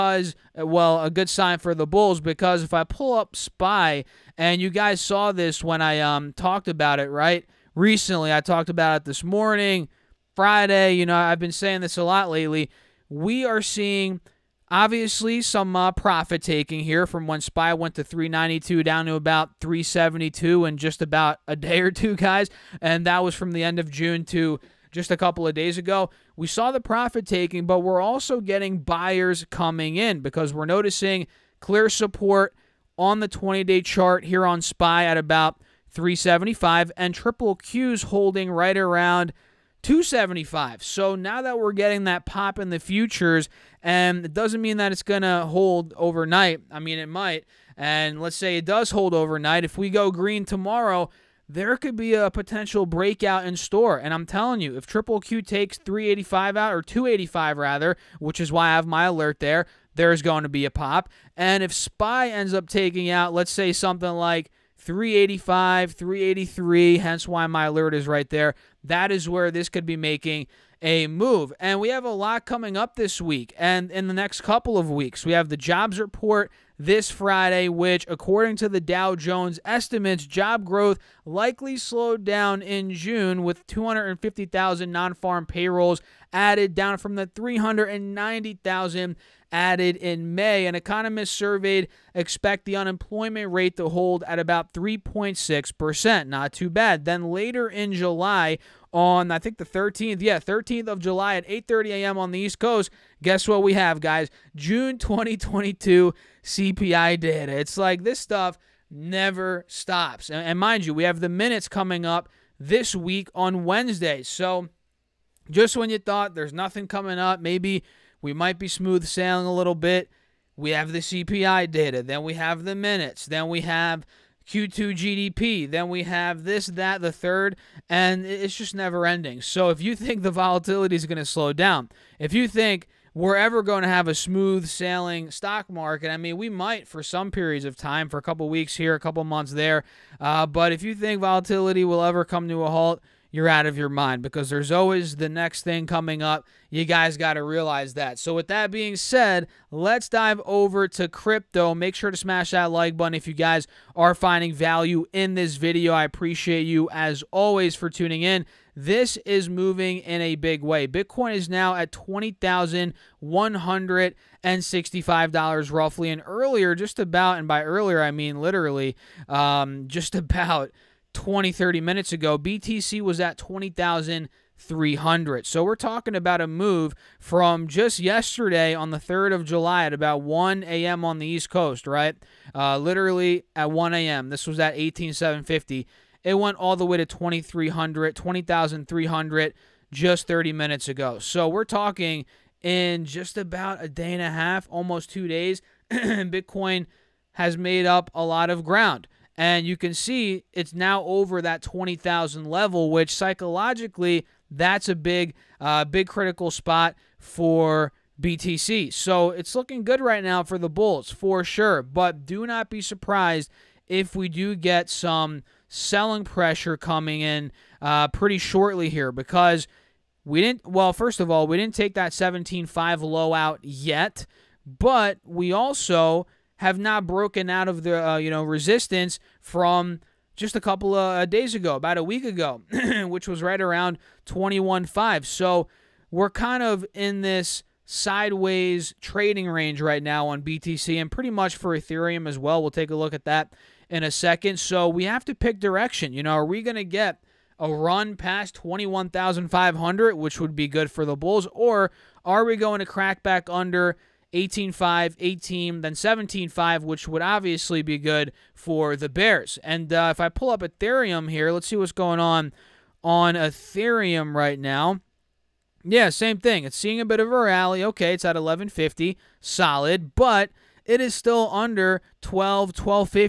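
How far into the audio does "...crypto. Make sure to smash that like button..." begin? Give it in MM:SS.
02:31.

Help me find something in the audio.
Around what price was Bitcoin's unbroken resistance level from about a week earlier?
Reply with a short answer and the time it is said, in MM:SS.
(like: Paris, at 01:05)
21.5, at 03:54.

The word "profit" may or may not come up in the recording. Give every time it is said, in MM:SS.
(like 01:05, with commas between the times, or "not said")
00:15, 00:26.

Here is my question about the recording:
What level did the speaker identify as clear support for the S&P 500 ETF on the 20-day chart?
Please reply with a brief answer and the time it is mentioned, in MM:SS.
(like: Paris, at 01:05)
375, at 00:35.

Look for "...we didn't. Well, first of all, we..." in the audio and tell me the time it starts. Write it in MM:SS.
03:40.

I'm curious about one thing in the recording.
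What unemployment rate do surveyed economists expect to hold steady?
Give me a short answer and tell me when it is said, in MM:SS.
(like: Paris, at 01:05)
3.6%, at 01:34.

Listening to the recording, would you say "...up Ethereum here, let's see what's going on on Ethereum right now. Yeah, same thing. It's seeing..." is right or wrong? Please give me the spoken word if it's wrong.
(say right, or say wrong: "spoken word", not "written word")
right.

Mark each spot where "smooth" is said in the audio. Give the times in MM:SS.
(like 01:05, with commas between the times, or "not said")
01:58, 02:14.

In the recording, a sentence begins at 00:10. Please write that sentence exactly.
You know, I've been saying this a lot lately.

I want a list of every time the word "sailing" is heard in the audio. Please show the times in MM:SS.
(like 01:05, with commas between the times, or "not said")
01:59, 02:14.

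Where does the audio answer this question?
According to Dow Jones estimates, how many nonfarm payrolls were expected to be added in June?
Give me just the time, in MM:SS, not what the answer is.
01:23.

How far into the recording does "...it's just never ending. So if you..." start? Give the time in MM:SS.
02:08.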